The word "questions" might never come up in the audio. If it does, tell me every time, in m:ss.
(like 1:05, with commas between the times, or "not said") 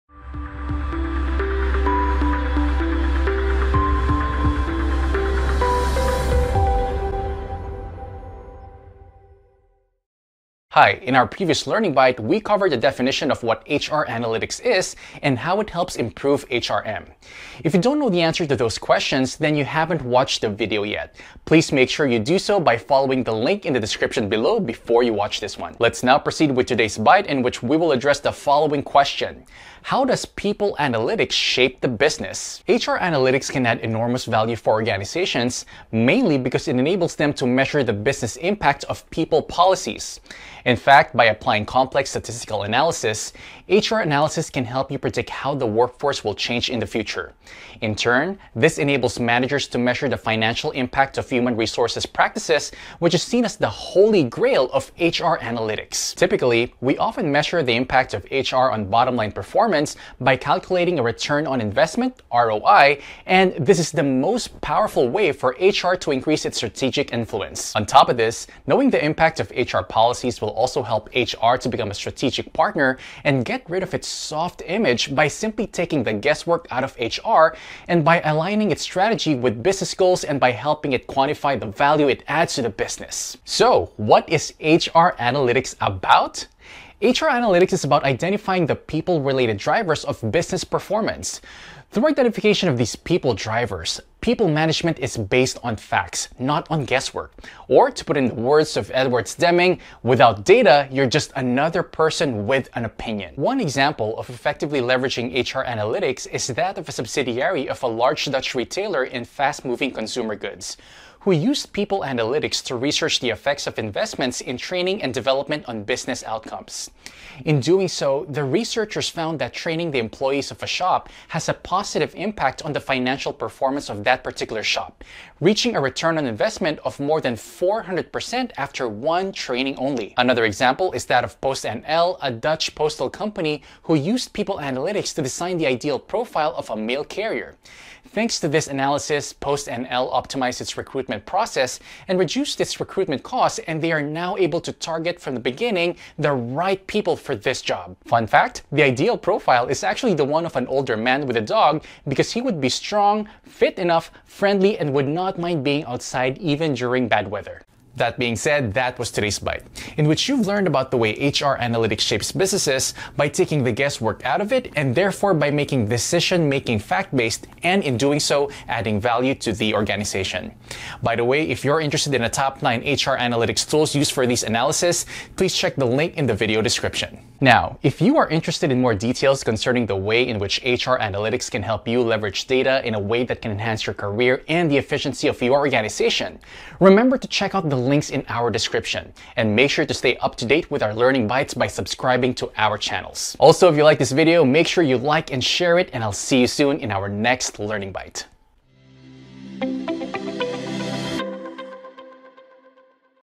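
0:18, 0:28.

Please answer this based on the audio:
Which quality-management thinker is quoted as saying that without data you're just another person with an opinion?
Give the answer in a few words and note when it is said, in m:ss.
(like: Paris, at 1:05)
Edward Deming, at 1:38.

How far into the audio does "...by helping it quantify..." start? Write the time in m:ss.
1:20.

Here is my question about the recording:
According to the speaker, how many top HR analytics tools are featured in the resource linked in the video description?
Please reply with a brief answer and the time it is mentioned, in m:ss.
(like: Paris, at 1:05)
9, at 2:52.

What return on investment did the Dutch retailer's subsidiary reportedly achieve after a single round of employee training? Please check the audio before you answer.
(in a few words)
more than 400%.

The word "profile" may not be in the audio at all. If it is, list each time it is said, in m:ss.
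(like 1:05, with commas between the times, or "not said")
2:15, 2:29.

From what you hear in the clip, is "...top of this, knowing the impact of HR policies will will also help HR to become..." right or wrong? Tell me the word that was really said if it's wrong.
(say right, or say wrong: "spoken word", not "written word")
right.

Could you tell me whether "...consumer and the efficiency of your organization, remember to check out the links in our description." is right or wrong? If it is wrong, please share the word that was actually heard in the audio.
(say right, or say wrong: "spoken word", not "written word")
wrong: "career", not "consumer".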